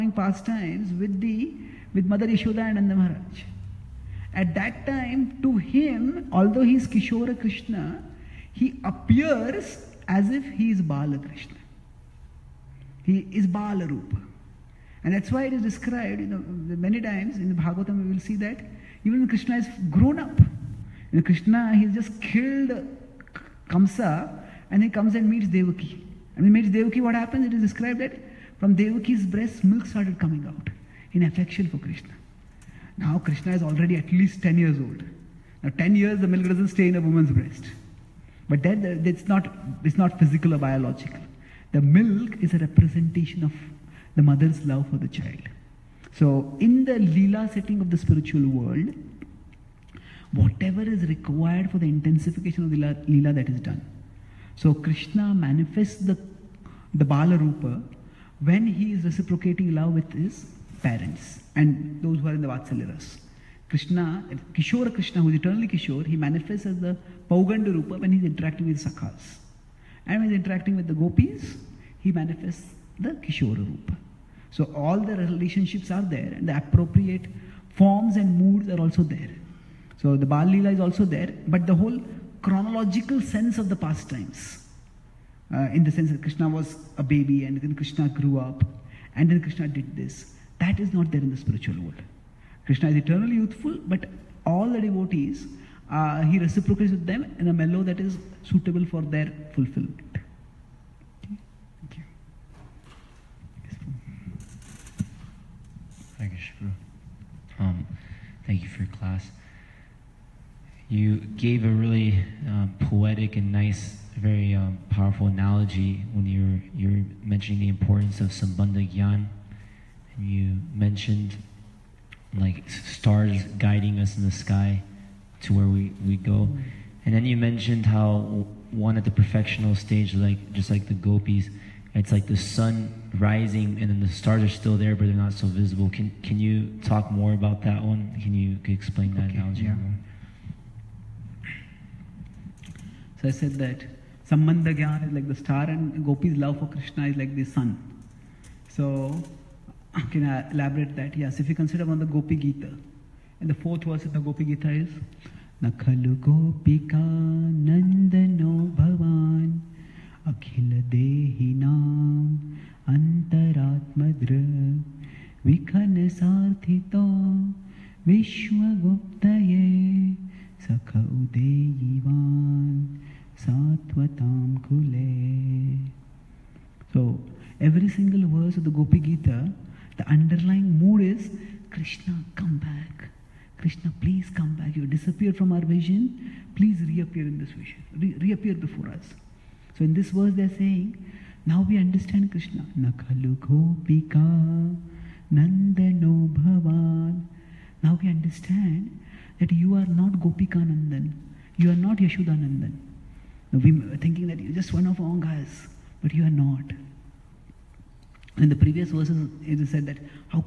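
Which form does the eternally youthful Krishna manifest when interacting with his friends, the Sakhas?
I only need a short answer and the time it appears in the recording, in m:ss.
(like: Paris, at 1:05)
Pauganda Rupa, at 1:07.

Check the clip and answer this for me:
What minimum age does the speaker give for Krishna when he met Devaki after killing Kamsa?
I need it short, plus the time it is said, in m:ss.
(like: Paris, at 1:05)
10, at 0:33.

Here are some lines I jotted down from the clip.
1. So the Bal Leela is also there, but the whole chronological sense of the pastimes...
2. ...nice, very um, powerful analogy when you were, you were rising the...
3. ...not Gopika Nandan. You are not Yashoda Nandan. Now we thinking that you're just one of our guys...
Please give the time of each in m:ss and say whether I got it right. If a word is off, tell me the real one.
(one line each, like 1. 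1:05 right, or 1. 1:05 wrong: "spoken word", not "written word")
1. 1:20 right
2. 1:53 wrong: "mentioning", not "rising"
3. 3:19 right.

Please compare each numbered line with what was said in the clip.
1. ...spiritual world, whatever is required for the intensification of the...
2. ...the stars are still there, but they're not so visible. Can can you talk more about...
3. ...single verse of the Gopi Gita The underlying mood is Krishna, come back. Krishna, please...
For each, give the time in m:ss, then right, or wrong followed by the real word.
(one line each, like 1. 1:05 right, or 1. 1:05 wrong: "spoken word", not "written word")
1. 0:47 right
2. 2:13 right
3. 2:57 right.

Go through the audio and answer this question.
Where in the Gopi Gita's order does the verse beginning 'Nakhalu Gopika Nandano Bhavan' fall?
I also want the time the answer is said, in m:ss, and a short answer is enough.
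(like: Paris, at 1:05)
Fourth, at 2:33.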